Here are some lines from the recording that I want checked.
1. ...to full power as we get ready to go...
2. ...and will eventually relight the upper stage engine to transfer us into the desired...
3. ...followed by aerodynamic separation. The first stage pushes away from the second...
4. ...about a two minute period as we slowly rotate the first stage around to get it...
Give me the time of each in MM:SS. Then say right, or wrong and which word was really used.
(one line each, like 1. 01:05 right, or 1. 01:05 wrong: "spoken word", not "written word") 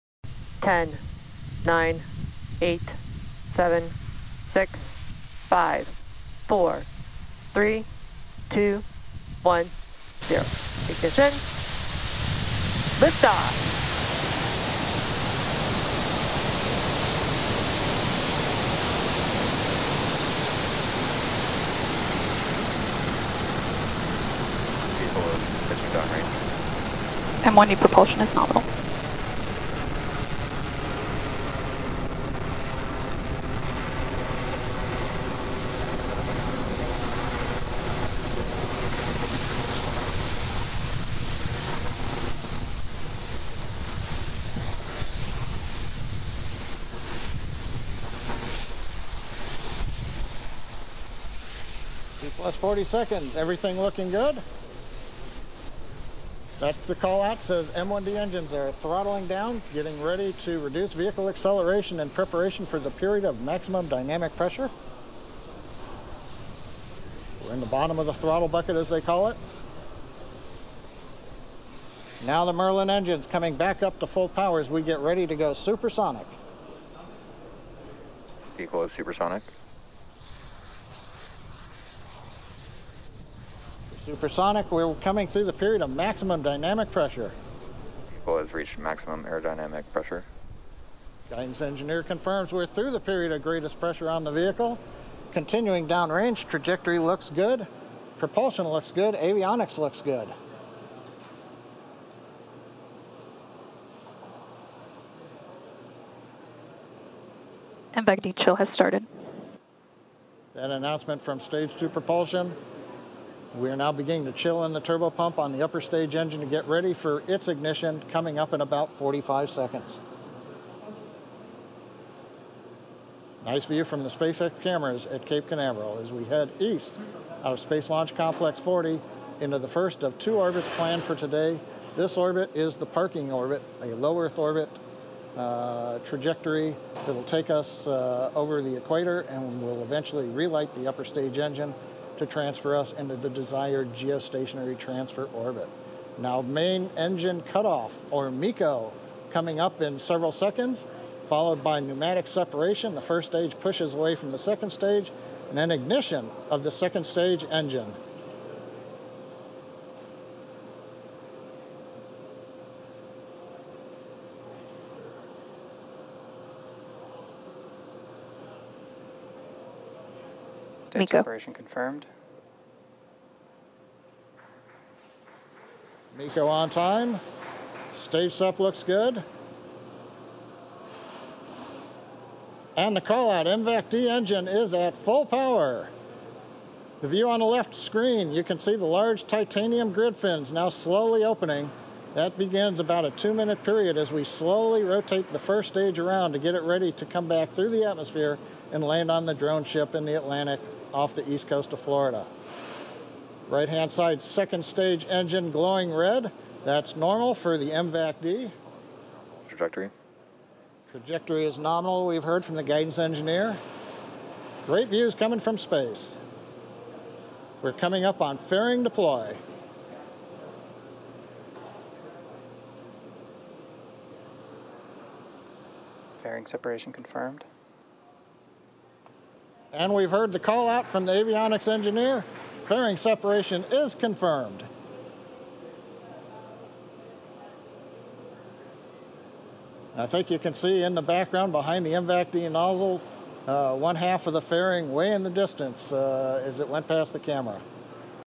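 1. 01:13 right
2. 02:19 right
3. 02:31 wrong: "pneumatic", not "aerodynamic"
4. 03:12 right.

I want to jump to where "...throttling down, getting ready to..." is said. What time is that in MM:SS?
00:58.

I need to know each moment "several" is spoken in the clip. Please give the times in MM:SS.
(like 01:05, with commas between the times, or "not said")
02:29.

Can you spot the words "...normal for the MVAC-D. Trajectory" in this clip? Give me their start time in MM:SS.
03:26.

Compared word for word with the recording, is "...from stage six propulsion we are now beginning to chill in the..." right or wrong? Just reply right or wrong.
wrong.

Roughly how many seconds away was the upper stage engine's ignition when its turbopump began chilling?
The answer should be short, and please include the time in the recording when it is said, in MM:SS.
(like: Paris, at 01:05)
45, at 01:58.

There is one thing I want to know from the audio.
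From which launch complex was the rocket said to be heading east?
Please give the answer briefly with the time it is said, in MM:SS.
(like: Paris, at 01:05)
Space Launch Complex 40, at 02:07.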